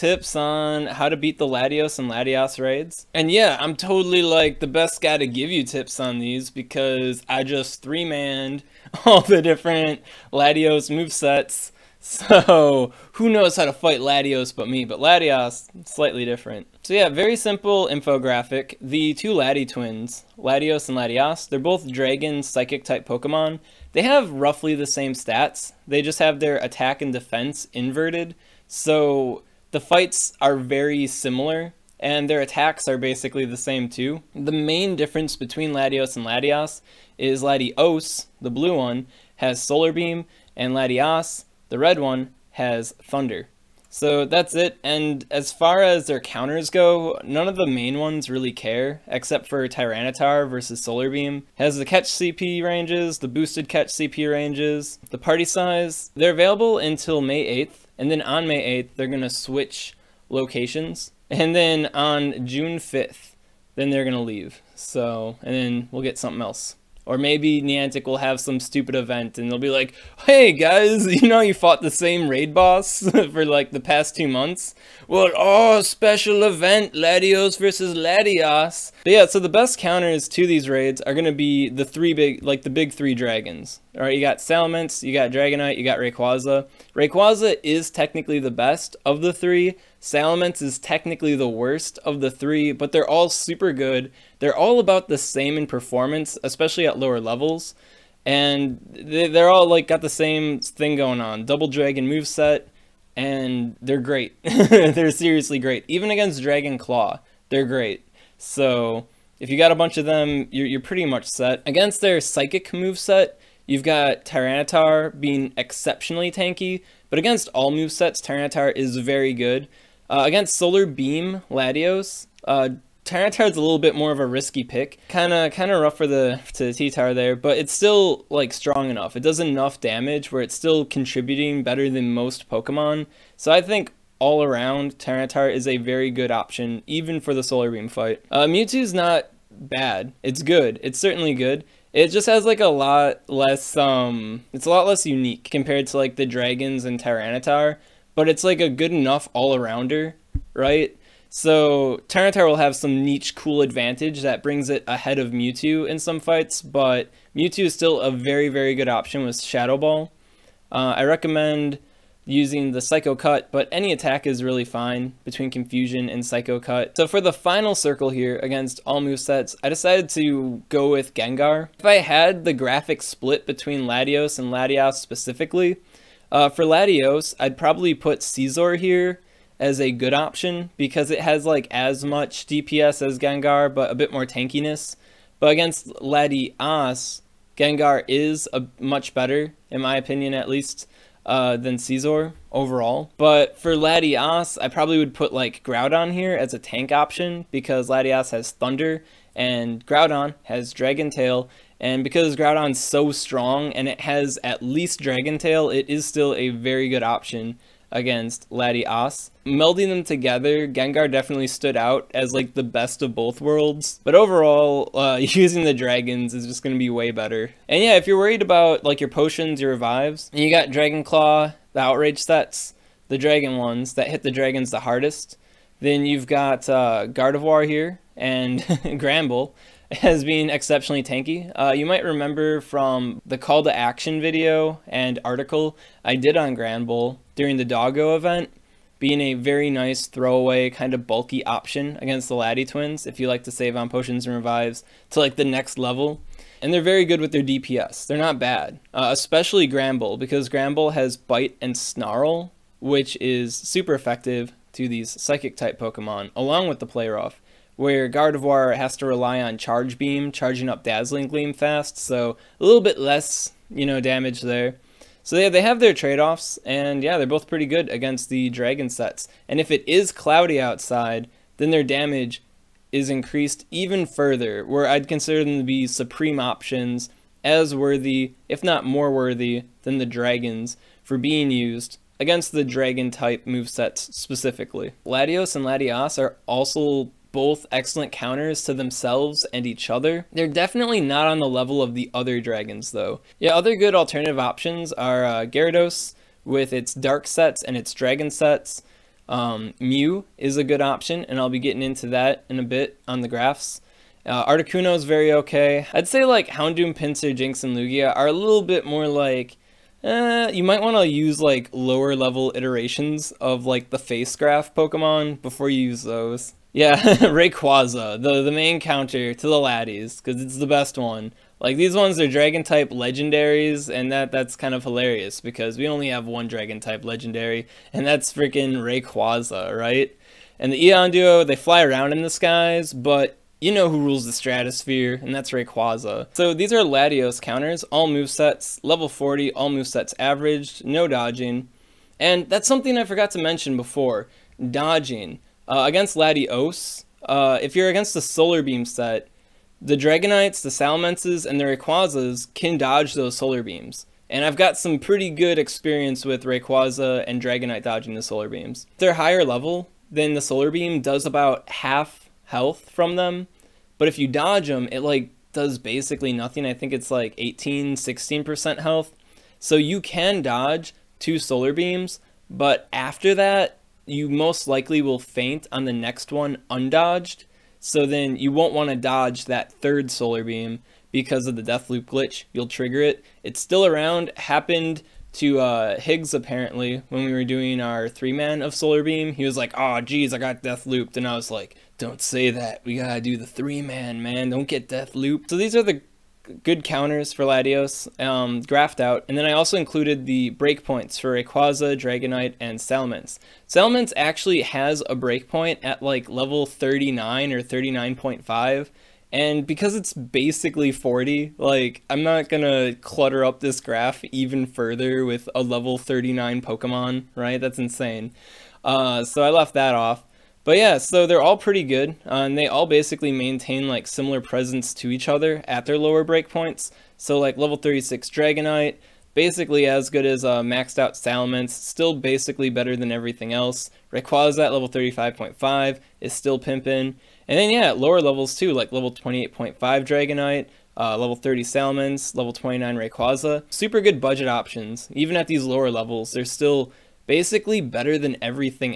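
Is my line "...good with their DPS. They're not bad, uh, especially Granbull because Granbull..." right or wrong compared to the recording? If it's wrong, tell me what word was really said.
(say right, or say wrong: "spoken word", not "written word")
right.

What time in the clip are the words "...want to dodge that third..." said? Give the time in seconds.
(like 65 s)
378 s.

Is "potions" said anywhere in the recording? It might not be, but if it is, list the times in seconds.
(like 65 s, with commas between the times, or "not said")
219 s, 243 s.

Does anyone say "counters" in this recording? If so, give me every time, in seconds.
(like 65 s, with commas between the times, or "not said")
46 s, 79 s, 288 s, 318 s, 337 s, 396 s.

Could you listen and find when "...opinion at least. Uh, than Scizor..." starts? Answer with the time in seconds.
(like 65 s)
189 s.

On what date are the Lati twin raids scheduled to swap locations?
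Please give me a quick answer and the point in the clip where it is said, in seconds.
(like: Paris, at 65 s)
May 8th, at 58 s.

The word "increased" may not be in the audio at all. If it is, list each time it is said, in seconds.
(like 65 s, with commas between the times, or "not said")
273 s.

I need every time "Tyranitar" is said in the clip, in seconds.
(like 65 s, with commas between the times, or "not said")
49 s, 114 s, 118 s, 123 s, 134 s, 146 s, 152 s.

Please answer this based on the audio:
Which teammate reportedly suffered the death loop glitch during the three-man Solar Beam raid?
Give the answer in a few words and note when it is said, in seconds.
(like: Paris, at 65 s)
Higgs, at 385 s.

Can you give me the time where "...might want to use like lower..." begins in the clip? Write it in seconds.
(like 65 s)
310 s.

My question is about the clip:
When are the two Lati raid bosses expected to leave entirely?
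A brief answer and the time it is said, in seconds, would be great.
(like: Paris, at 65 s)
June 5th, at 62 s.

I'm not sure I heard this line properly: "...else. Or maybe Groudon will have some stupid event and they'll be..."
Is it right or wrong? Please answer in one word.
wrong.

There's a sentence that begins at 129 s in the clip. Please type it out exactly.
It does enough damage where it's still contributing better than most Pokemon.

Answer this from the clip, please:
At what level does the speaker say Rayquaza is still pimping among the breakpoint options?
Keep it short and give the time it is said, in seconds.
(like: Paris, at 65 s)
35.5, at 434 s.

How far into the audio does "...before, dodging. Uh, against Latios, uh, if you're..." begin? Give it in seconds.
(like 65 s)
343 s.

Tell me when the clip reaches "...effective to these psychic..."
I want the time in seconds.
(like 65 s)
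253 s.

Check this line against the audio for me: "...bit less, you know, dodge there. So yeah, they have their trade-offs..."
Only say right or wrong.
wrong.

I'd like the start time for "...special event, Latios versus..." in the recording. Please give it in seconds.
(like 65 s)
75 s.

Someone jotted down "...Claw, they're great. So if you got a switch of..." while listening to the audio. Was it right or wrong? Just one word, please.
wrong.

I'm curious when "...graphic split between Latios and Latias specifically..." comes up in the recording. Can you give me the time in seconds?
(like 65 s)
172 s.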